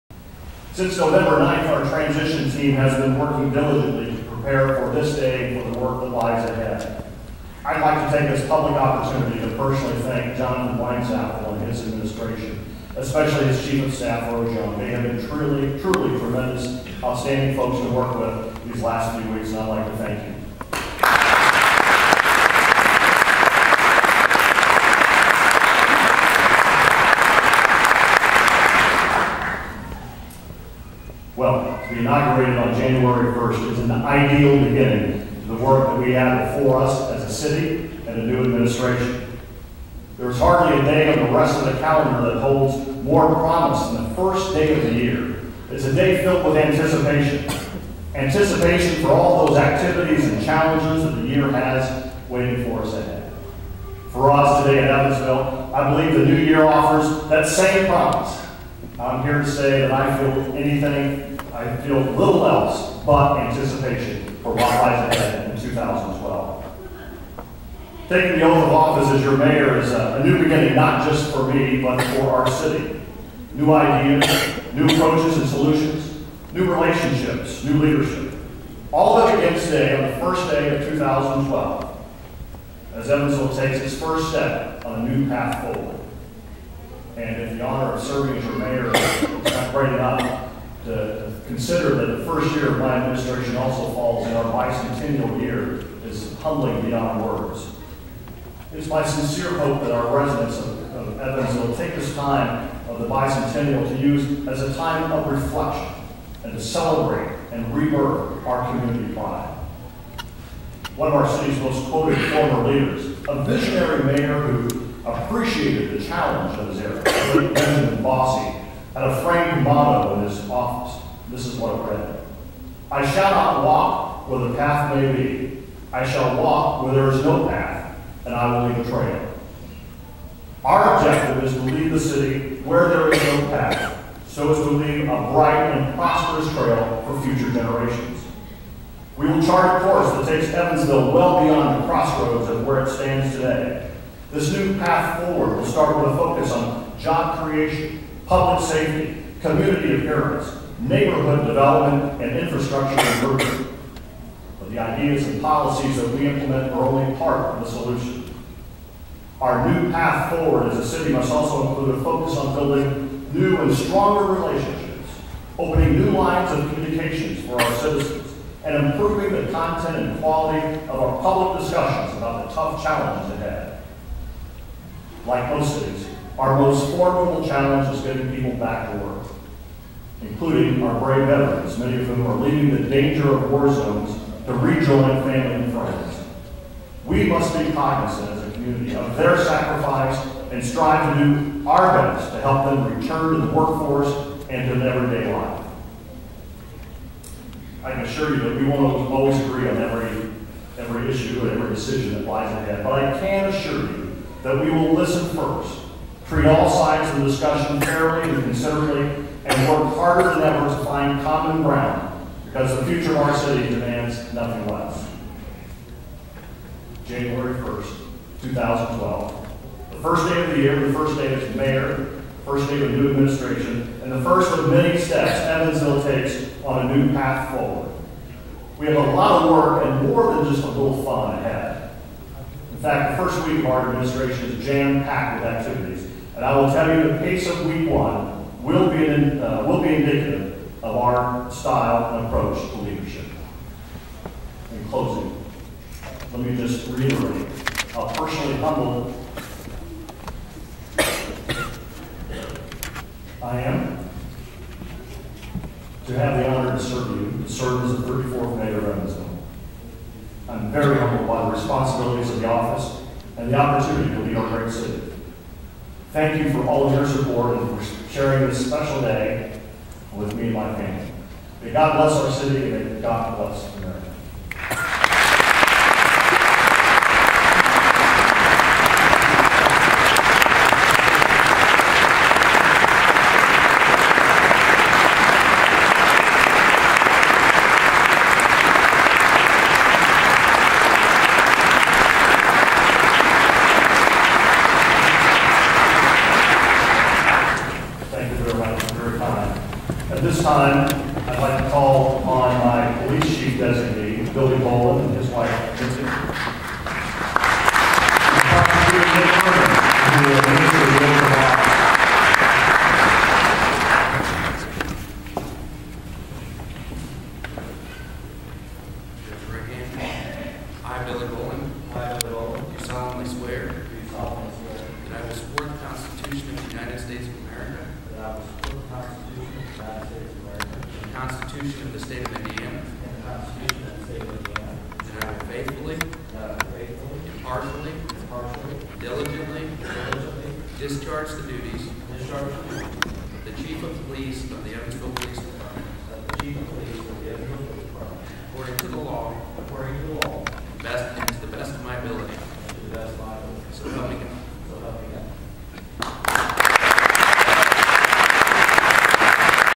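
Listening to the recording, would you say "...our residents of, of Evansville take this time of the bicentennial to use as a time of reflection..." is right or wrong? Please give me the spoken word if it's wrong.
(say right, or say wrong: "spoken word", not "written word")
right.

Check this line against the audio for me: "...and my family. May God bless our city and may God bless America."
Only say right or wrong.
right.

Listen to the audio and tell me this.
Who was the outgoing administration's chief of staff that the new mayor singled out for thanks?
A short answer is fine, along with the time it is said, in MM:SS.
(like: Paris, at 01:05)
Rose Young, at 00:14.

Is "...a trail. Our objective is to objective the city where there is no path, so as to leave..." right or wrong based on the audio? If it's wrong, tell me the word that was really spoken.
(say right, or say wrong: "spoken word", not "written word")
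wrong: "leave", not "objective".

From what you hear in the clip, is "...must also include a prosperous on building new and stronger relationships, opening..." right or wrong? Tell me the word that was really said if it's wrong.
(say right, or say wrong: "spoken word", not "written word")
wrong: "focus", not "prosperous".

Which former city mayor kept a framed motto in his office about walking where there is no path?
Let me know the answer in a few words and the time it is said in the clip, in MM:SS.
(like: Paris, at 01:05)
Benjamin Bosse, at 01:57.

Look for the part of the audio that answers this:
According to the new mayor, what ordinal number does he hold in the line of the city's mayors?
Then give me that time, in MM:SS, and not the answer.
04:18.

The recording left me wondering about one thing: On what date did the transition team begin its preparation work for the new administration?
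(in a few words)
November 9th.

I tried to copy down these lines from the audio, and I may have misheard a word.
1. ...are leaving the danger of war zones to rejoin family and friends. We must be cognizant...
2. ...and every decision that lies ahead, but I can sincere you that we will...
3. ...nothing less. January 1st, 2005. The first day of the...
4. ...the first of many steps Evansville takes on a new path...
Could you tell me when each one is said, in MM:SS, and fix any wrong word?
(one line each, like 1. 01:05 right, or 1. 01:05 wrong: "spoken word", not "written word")
1. 03:02 right
2. 03:21 wrong: "assure", not "sincere"
3. 03:34 wrong: "2012", not "2005"
4. 03:44 right.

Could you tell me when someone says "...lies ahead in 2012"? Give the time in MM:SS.
01:04.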